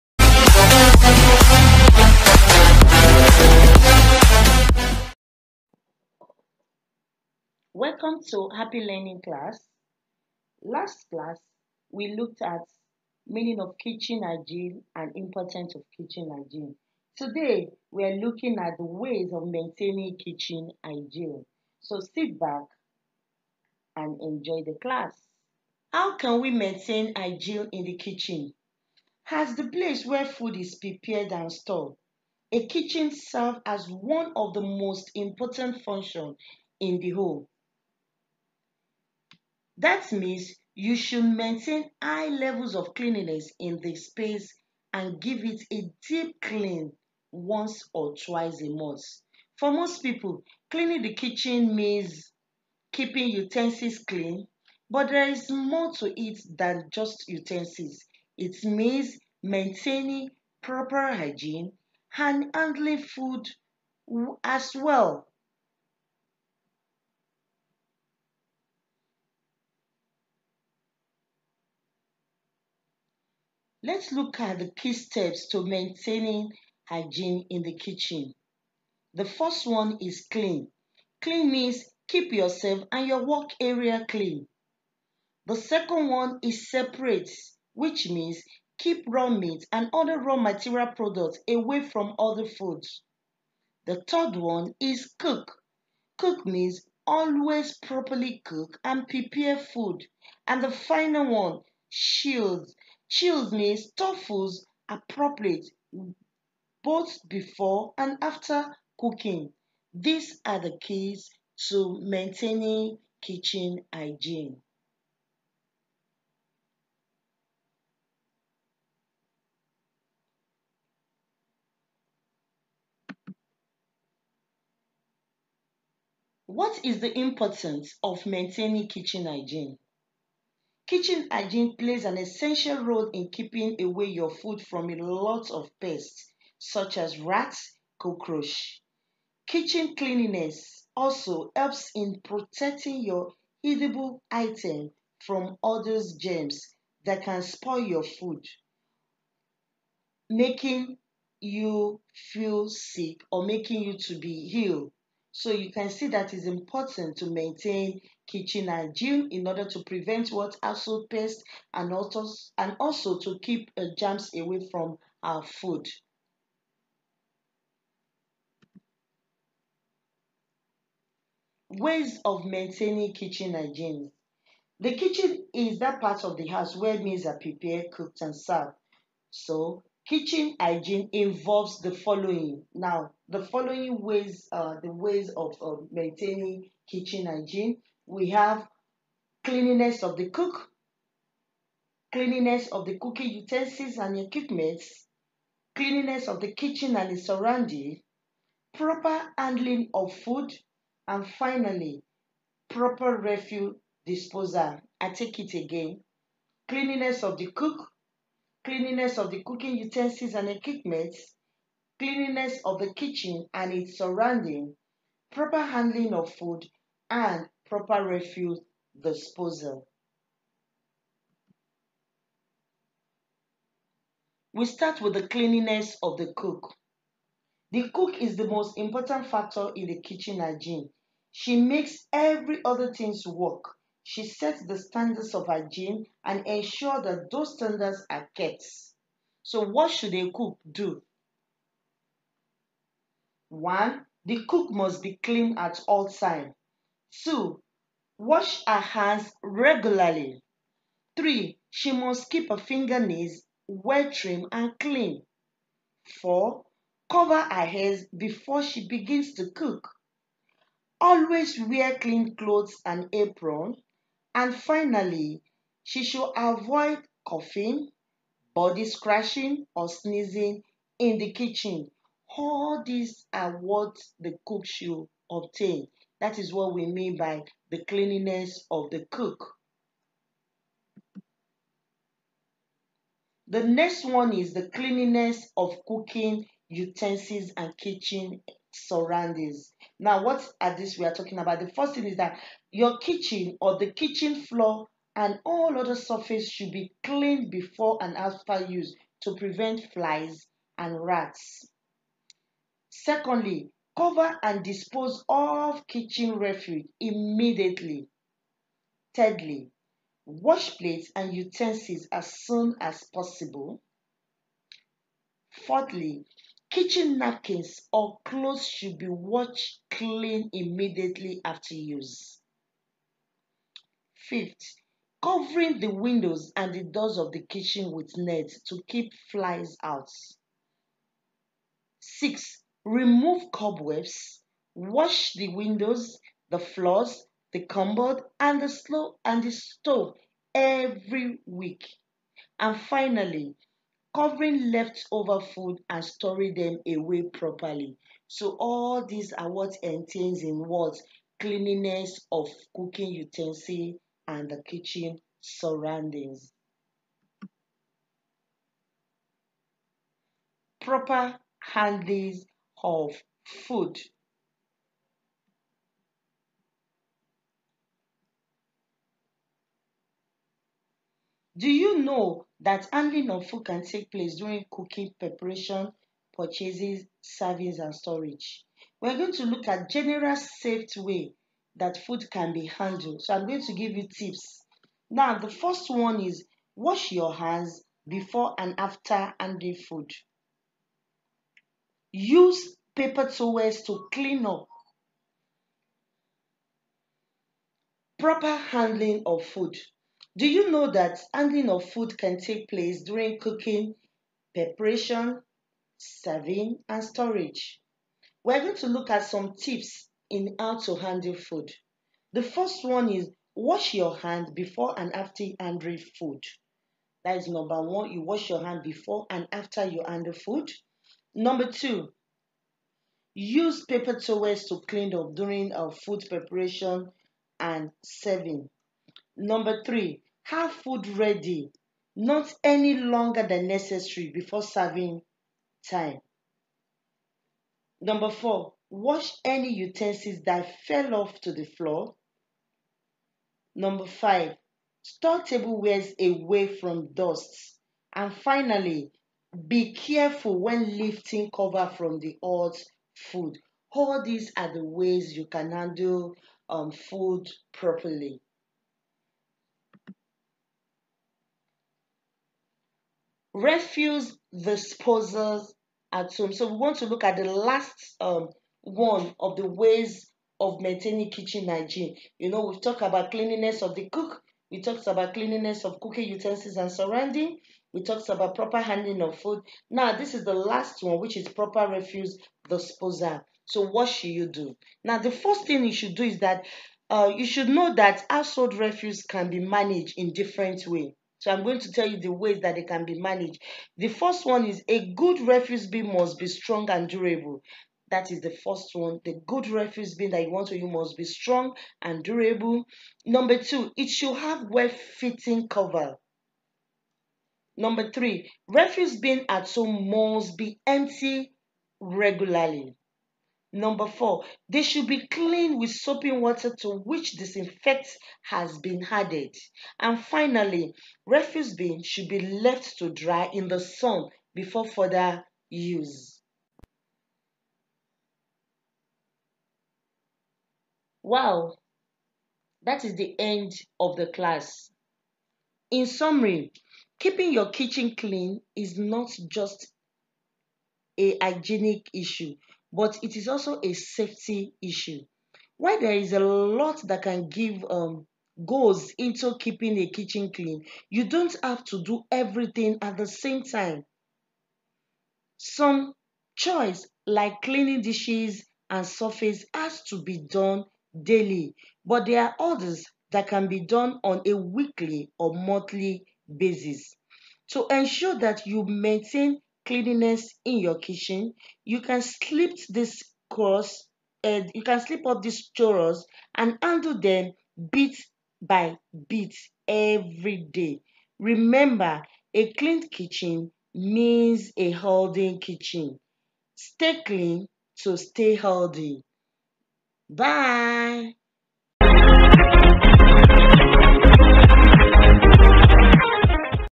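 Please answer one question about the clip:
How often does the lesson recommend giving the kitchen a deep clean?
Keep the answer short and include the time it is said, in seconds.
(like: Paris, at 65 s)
Once or twice a month, at 47 s.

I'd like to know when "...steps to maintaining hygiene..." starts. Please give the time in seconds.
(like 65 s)
74 s.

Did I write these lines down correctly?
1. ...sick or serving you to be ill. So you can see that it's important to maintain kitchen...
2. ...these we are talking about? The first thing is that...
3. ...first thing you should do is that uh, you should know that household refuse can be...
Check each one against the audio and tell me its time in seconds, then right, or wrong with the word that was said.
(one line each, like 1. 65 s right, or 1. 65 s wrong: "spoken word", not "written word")
1. 152 s wrong: "making", not "serving"
2. 290 s right
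3. 485 s right.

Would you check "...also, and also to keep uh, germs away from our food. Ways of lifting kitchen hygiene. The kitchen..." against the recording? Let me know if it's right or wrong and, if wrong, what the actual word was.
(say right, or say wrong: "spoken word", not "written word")
wrong: "maintaining", not "lifting".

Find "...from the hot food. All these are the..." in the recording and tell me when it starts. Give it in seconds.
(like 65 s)
451 s.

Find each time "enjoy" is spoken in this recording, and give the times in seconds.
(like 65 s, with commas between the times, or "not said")
24 s.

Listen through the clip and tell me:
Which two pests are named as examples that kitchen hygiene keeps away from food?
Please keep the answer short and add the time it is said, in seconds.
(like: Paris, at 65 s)
Rats, cockroach, at 137 s.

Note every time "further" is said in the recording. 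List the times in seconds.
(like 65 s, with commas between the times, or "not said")
524 s.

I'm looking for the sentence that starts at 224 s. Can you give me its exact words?
We start with the cleanliness of the cook.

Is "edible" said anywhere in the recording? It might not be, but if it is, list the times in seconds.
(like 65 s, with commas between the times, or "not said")
143 s.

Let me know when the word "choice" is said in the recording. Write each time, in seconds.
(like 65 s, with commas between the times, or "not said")
556 s.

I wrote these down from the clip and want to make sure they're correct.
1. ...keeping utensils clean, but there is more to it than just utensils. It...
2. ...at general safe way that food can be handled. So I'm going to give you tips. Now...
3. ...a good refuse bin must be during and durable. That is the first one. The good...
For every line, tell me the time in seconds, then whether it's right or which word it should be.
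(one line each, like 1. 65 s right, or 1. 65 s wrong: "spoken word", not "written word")
1. 52 s right
2. 379 s right
3. 494 s wrong: "strong", not "during".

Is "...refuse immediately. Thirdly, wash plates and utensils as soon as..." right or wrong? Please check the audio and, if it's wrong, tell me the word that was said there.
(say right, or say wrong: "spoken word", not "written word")
right.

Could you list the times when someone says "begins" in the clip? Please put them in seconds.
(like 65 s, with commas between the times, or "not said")
258 s.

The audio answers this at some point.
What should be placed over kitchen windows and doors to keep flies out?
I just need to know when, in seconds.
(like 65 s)
328 s.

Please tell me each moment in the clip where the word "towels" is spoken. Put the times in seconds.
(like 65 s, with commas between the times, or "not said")
393 s, 424 s.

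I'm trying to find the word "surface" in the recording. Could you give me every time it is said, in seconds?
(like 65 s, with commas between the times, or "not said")
295 s, 559 s.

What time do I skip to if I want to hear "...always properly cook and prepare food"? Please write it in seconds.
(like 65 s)
97 s.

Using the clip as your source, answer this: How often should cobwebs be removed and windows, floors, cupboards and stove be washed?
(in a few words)
Every week.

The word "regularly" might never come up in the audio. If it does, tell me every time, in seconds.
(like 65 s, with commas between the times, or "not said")
249 s, 511 s.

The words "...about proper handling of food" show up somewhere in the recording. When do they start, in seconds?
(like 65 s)
478 s.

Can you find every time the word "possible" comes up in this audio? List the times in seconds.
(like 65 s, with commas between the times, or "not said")
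313 s.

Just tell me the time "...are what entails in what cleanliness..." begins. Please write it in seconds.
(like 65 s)
349 s.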